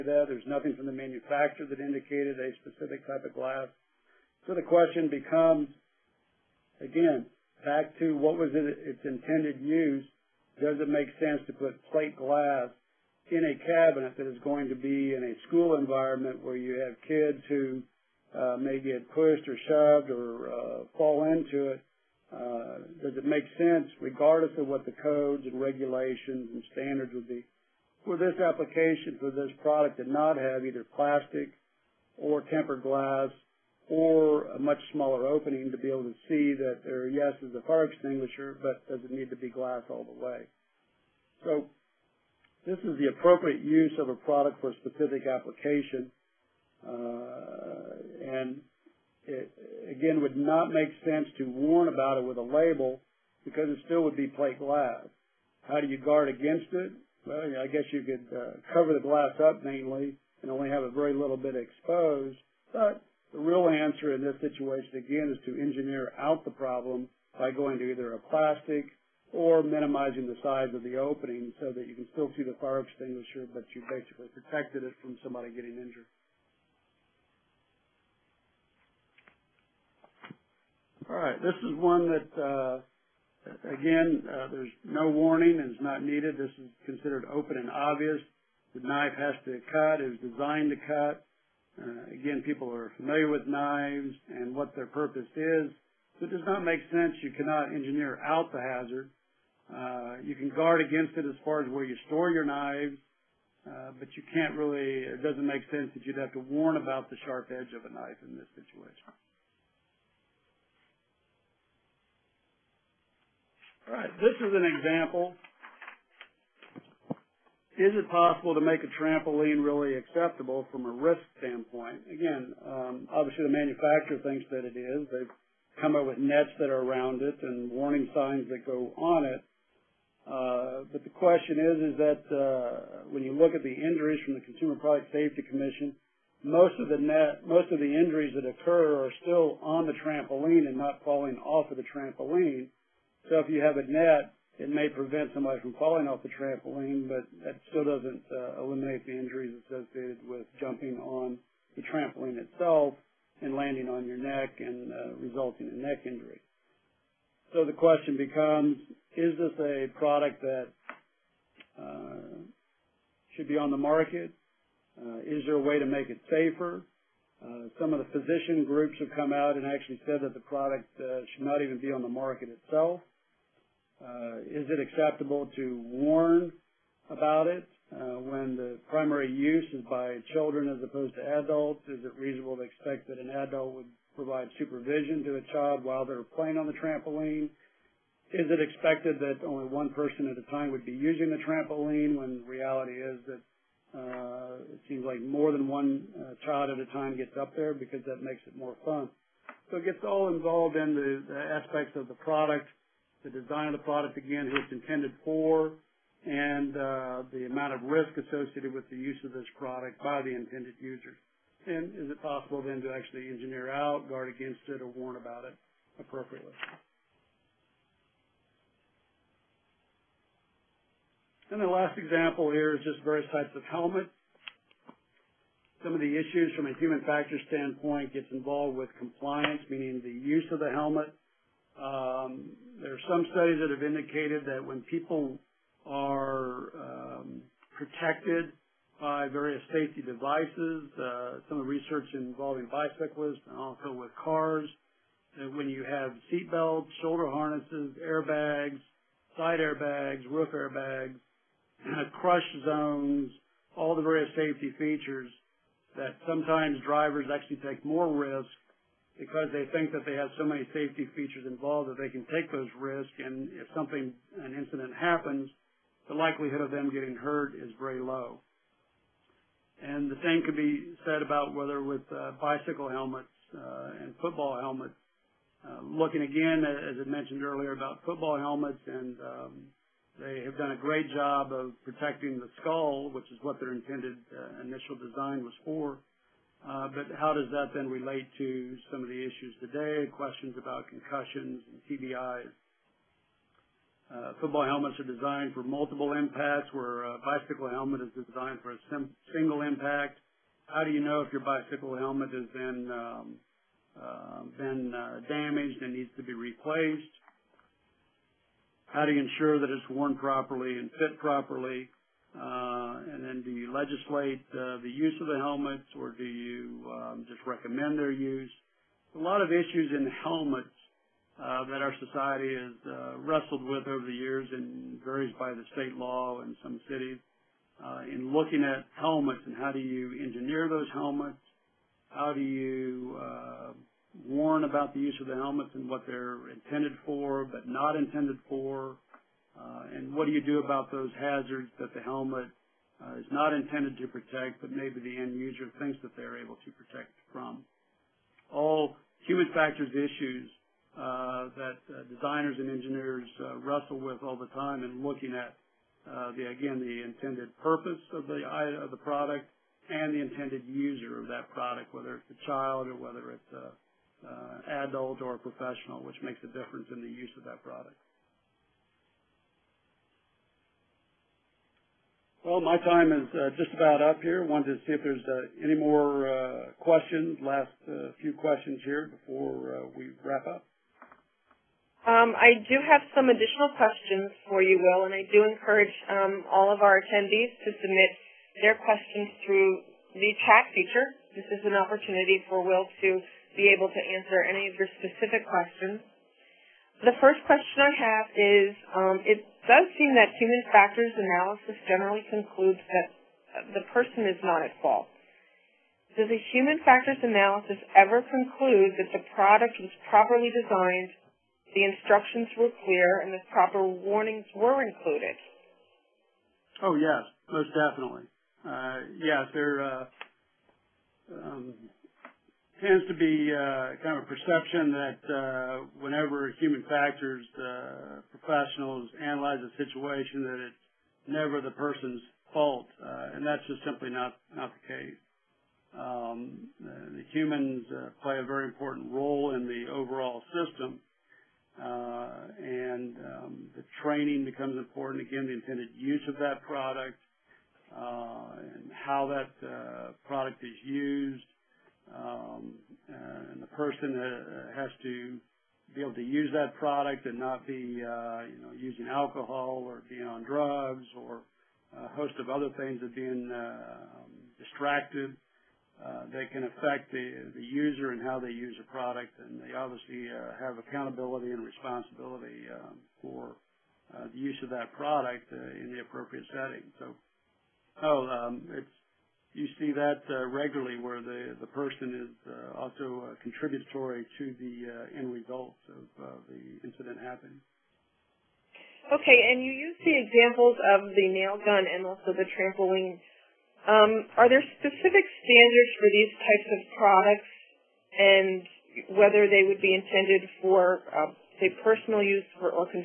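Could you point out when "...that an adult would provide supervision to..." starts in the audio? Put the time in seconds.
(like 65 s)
183 s.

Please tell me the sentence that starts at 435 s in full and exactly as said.
Um, the humans uh, play a very important role in the overall system, uh, and um, the training becomes important.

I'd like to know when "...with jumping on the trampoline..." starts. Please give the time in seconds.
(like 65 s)
150 s.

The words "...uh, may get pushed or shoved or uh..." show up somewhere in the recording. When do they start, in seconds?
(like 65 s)
18 s.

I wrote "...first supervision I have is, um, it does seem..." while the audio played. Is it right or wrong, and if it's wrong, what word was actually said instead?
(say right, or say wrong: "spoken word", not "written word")
wrong: "question", not "supervision".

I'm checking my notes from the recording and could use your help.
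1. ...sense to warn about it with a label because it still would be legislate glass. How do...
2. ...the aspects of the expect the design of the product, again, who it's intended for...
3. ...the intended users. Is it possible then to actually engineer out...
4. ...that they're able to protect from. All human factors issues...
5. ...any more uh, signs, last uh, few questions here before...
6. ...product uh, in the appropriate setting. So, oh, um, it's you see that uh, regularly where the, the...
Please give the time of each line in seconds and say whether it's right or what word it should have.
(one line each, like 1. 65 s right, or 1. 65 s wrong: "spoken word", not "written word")
1. 51 s wrong: "plate", not "legislate"
2. 201 s wrong: "product", not "expect"
3. 210 s right
4. 346 s right
5. 375 s wrong: "questions", not "signs"
6. 474 s right.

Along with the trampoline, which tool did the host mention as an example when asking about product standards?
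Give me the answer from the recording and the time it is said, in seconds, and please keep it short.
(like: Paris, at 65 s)
Nail gun, at 491 s.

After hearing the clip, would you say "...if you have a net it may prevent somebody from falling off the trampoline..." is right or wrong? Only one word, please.
right.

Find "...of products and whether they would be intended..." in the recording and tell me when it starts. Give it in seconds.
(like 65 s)
496 s.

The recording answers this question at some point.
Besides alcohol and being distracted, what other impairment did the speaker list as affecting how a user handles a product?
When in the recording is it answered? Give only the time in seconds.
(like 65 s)
460 s.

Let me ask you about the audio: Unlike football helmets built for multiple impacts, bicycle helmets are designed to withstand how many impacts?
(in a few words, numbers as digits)
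A single impact.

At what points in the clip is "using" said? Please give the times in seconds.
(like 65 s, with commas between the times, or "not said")
190 s, 458 s.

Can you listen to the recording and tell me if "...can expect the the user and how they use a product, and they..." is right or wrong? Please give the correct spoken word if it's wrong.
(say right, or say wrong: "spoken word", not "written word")
wrong: "affect", not "expect".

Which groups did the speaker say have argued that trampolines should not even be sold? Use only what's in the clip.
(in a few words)
Physician groups.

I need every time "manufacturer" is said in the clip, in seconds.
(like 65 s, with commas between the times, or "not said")
0 s, 123 s.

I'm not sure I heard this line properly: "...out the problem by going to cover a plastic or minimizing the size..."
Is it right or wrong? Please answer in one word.
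wrong.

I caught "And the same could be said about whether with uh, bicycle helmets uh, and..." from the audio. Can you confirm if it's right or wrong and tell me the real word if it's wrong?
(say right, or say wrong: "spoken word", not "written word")
right.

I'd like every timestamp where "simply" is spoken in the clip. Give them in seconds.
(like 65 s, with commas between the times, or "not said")
433 s.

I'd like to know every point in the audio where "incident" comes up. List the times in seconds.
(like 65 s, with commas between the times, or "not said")
264 s, 486 s.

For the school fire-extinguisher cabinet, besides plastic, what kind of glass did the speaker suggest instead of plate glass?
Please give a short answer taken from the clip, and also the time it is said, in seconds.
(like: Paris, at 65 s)
Tempered glass, at 32 s.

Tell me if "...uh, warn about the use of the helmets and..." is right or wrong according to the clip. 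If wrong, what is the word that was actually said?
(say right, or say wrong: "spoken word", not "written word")
right.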